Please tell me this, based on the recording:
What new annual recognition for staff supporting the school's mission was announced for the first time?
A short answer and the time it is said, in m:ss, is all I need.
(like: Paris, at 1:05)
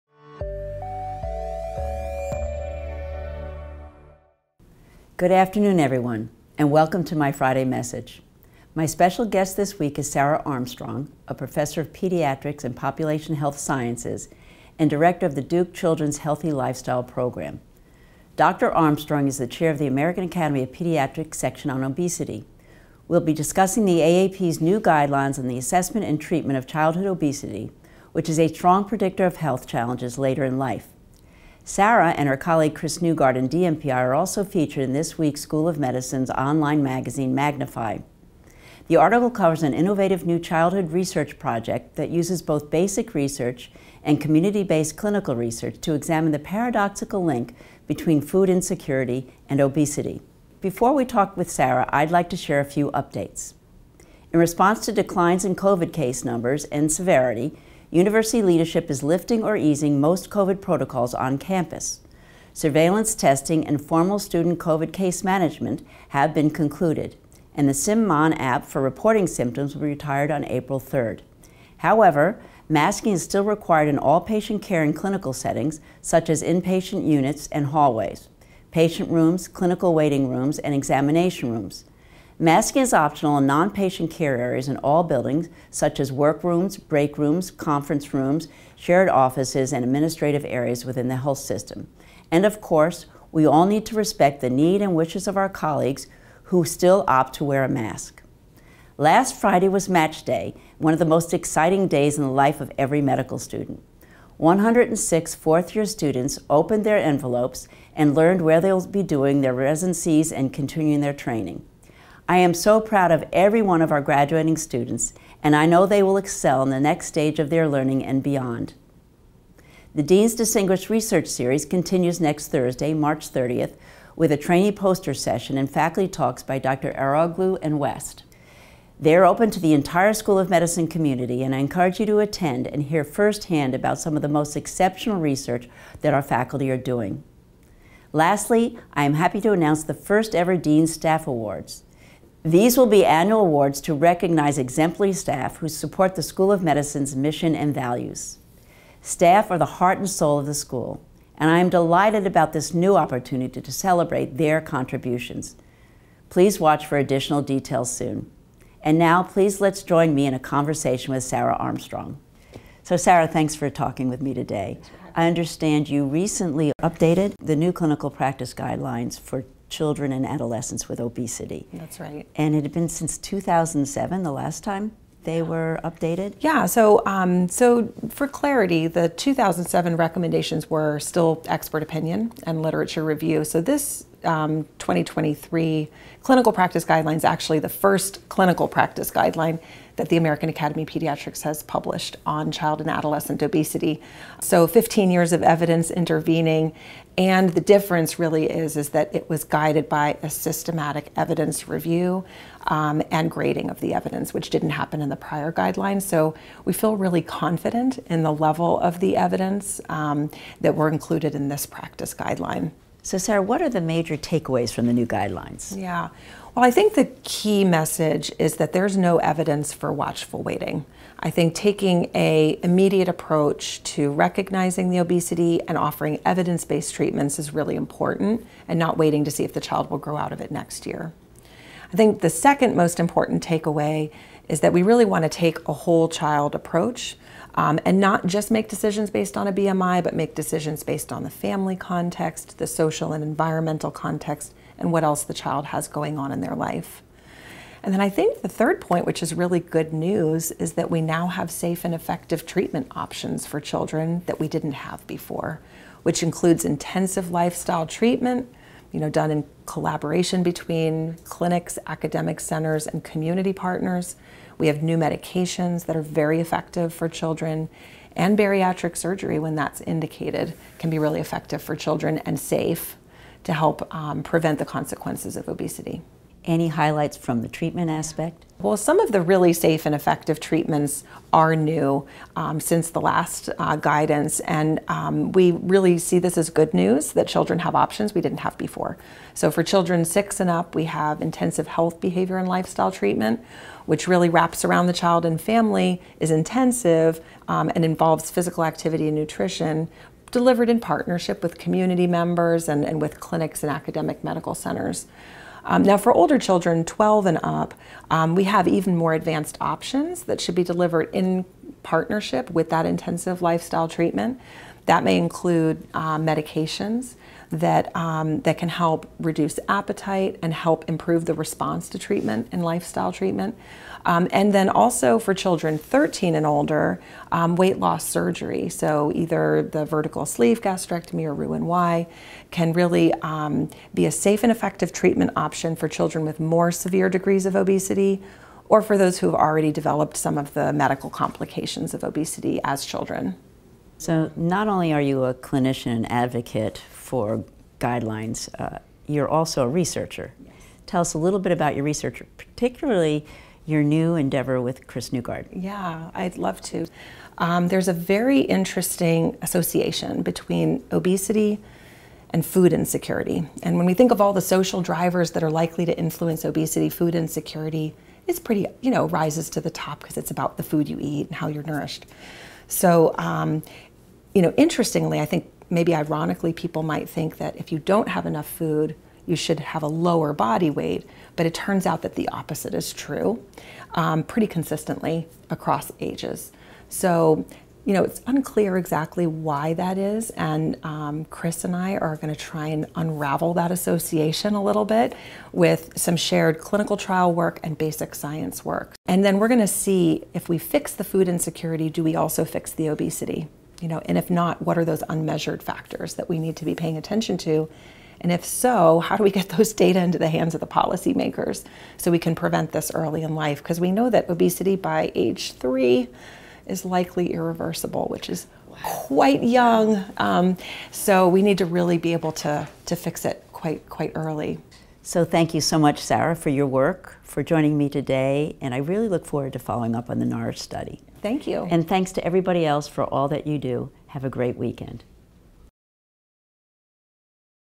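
Dean's Staff Awards, at 2:20.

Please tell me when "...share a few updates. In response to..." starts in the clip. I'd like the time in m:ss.
0:52.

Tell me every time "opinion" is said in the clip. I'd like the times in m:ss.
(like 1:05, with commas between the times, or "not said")
3:01.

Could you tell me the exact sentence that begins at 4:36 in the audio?
Any highlights from the treatment aspect?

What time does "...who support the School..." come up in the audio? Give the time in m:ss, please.
2:25.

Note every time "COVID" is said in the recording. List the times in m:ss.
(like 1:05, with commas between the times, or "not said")
0:55, 1:00, 1:04.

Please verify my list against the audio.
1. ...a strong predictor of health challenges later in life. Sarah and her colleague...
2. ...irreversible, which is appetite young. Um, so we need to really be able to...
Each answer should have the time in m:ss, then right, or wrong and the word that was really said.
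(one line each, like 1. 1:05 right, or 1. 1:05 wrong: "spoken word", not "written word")
1. 0:28 right
2. 6:57 wrong: "quite", not "appetite".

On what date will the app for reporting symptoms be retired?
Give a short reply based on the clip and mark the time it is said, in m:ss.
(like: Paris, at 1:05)
April 3rd, at 1:10.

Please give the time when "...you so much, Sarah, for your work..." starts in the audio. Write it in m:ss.
7:05.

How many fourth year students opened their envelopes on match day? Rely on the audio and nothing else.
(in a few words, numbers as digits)
106.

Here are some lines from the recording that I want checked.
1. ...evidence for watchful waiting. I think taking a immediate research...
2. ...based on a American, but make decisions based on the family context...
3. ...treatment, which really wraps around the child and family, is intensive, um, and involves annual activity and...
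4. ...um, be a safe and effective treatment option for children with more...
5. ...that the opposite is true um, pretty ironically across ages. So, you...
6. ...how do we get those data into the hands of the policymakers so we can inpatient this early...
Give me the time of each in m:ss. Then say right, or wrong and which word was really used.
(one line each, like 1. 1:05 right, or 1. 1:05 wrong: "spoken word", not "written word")
1. 3:39 wrong: "approach", not "research"
2. 3:59 wrong: "BMI", not "American"
3. 4:52 wrong: "physical", not "annual"
4. 5:33 right
5. 6:22 wrong: "consistently", not "ironically"
6. 6:48 wrong: "prevent", not "inpatient".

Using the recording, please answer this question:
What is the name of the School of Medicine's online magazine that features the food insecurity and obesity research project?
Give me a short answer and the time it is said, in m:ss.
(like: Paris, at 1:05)
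Magnify, at 0:37.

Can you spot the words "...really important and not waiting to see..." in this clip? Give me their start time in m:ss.
3:47.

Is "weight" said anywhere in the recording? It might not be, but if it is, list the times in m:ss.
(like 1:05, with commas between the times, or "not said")
5:27, 6:20.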